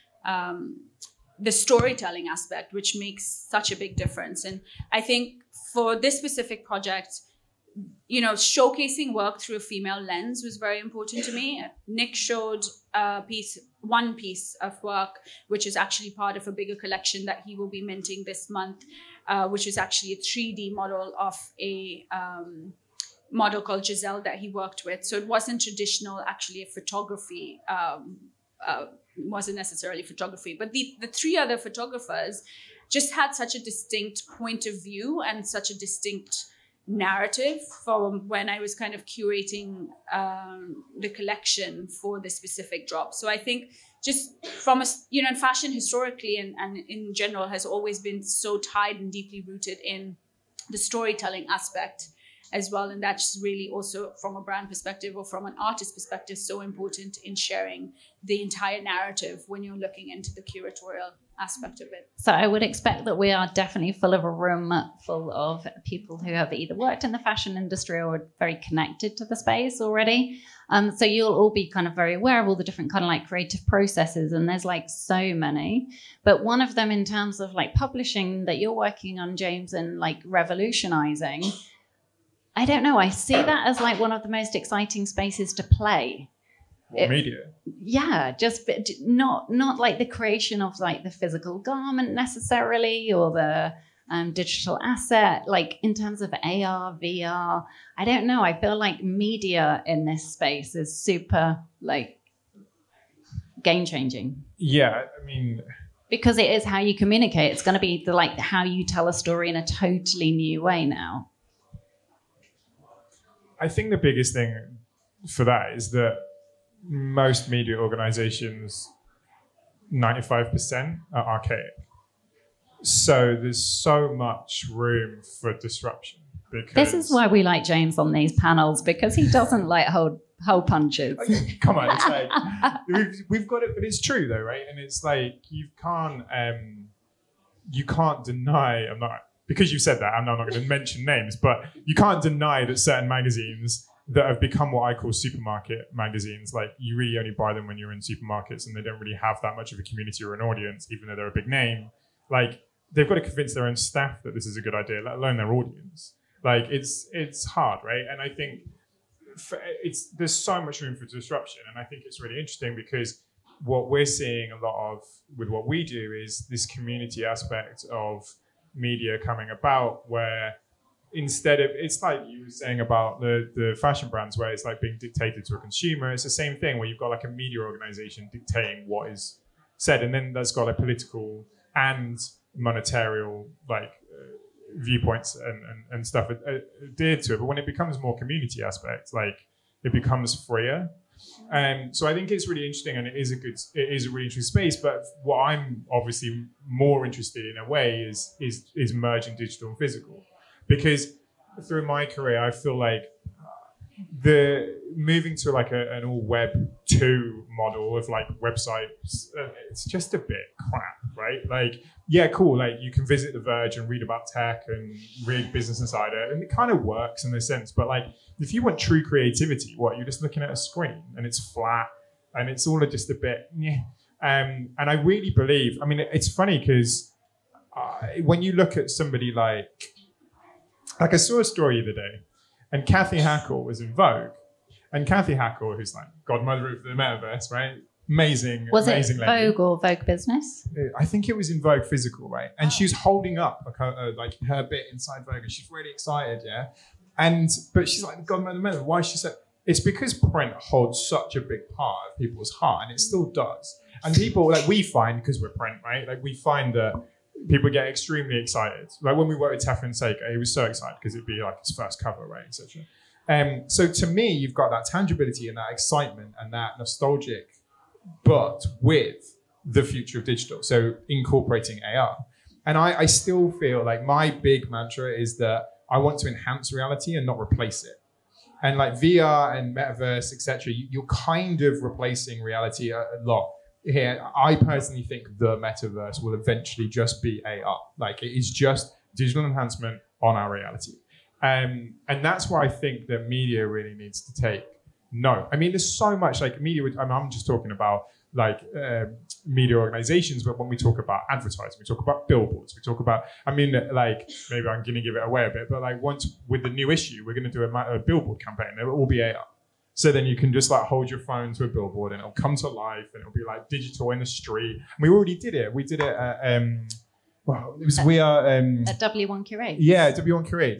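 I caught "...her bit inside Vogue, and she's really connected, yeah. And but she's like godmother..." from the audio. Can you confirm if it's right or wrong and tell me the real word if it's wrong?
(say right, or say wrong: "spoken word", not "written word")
wrong: "excited", not "connected".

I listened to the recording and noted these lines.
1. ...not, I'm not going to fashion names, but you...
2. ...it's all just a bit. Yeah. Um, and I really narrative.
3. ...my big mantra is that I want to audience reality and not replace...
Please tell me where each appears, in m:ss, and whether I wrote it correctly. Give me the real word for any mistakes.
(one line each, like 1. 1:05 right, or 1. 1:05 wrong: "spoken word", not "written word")
1. 2:20 wrong: "mention", not "fashion"
2. 3:42 wrong: "believe", not "narrative"
3. 4:34 wrong: "enhance", not "audience".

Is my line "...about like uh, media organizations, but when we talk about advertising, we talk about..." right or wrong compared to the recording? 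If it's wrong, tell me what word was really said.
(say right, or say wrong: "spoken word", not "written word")
right.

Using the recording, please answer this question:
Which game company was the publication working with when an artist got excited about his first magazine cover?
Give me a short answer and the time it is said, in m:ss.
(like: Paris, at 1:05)
Sega, at 4:19.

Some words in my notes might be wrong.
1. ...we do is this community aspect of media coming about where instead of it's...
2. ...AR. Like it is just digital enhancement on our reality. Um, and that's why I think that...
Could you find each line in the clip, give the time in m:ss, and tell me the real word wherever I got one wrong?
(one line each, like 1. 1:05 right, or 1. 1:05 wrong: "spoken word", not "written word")
1. 2:45 right
2. 4:47 right.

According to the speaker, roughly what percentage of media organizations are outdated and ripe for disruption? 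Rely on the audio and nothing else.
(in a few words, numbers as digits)
95%.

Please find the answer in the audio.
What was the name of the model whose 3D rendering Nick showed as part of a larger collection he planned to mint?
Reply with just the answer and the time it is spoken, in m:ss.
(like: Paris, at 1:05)
Giselle, at 0:23.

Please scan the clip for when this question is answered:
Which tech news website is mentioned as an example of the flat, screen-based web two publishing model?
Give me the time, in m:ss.
3:33.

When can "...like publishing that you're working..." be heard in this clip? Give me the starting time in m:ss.
1:17.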